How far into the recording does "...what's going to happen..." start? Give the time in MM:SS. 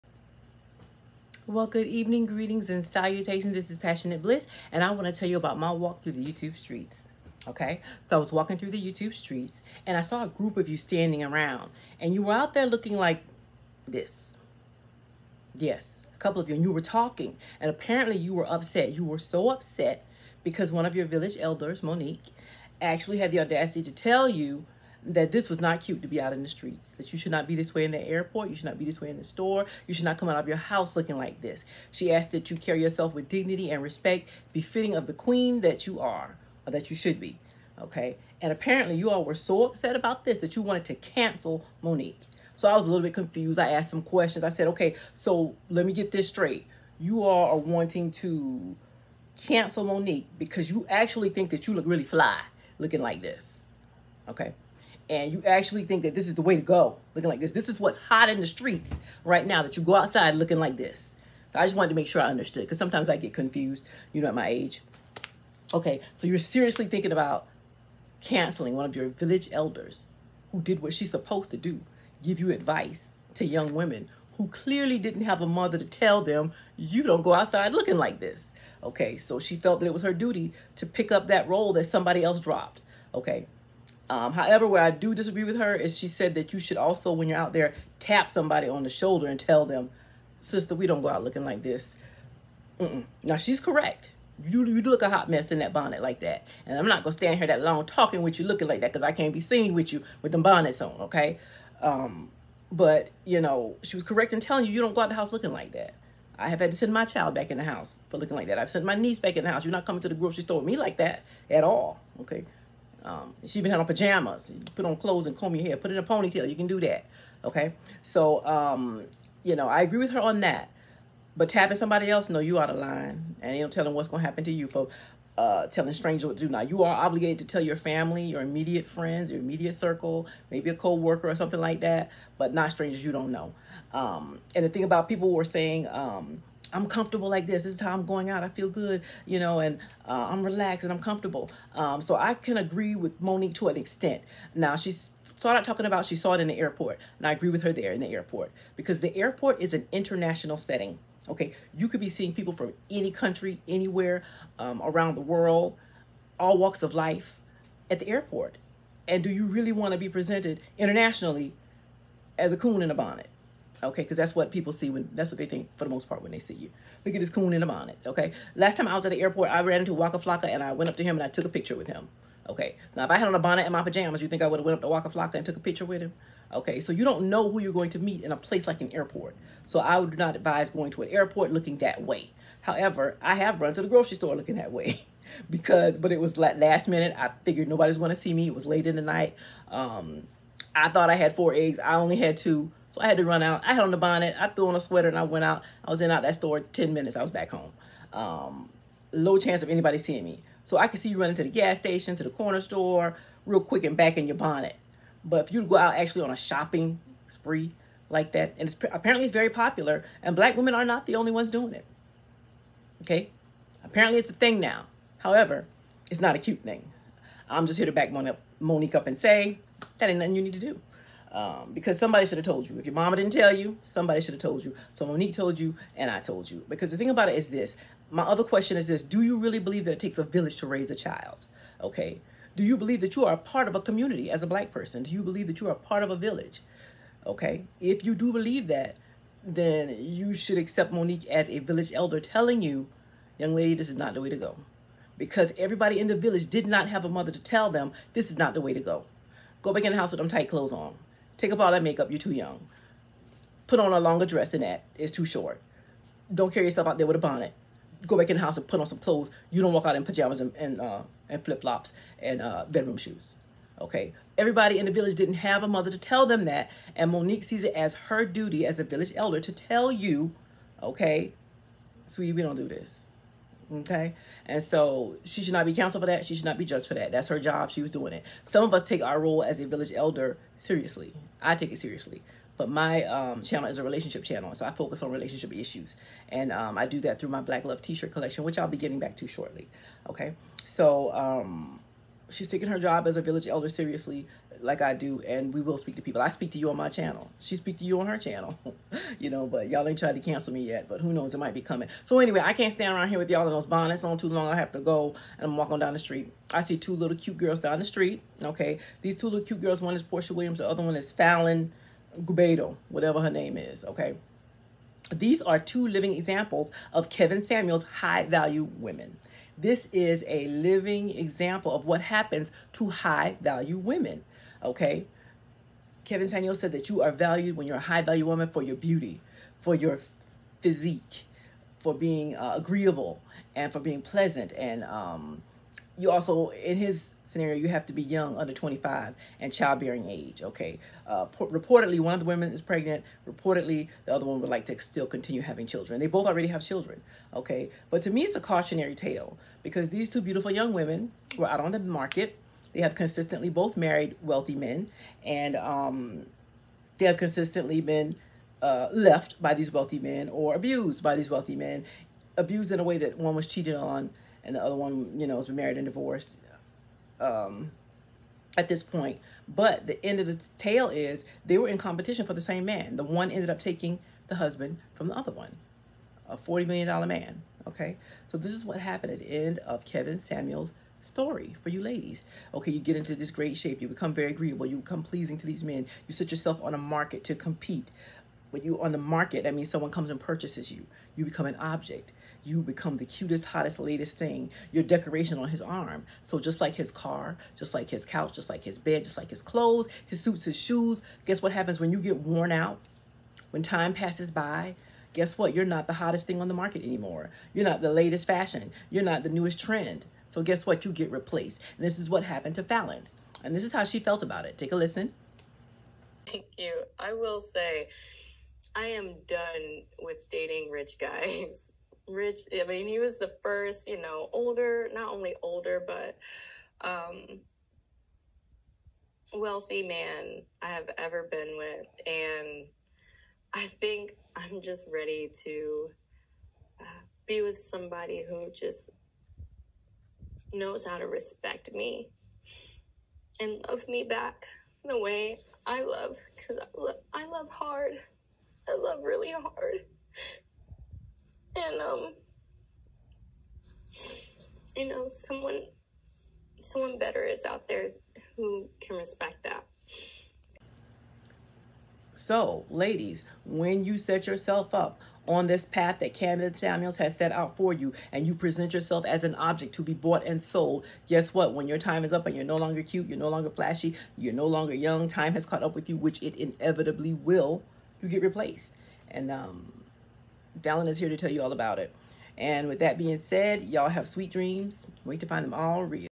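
02:03.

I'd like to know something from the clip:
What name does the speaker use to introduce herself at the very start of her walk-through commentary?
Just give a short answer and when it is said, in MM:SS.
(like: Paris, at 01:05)
Passionate Bliss, at 00:03.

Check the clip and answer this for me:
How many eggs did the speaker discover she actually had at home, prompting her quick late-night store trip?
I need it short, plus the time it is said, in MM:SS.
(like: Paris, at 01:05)
2, at 03:11.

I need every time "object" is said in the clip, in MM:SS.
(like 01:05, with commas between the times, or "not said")
06:31, 07:49.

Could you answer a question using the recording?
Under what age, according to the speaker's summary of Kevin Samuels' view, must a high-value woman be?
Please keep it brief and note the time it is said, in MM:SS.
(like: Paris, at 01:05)
25, at 05:38.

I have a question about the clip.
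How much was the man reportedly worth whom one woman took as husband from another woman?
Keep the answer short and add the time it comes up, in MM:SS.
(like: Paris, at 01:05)
$40 million, at 06:16.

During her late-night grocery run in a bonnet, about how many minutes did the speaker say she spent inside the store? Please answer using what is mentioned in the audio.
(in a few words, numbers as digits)
10.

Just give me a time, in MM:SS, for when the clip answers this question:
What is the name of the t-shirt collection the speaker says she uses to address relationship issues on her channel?
04:47.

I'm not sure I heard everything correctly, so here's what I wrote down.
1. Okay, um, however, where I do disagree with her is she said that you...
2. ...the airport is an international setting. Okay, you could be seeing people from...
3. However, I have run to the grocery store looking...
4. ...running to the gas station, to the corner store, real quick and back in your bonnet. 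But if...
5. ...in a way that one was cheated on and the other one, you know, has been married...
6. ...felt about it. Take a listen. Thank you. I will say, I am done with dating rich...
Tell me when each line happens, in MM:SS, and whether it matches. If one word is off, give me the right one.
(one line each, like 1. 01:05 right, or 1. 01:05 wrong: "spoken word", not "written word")
1. 01:23 right
2. 02:29 right
3. 03:02 right
4. 03:21 right
5. 06:02 right
6. 06:53 right.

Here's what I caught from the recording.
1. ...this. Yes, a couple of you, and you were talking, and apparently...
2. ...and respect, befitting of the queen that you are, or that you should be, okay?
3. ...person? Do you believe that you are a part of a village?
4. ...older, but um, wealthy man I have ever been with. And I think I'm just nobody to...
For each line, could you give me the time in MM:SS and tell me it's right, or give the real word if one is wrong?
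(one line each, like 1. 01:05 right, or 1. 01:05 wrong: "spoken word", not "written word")
1. 00:13 right
2. 00:33 right
3. 03:54 right
4. 07:05 wrong: "ready", not "nobody".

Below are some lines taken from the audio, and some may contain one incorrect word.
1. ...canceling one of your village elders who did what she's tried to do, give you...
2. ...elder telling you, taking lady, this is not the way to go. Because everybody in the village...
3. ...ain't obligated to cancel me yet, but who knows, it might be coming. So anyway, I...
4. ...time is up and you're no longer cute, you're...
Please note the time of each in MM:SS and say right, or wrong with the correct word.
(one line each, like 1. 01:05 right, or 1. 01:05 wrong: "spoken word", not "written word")
1. 01:08 wrong: "supposed", not "tried"
2. 04:01 wrong: "young", not "taking"
3. 04:59 wrong: "tried", not "obligated"
4. 07:51 right.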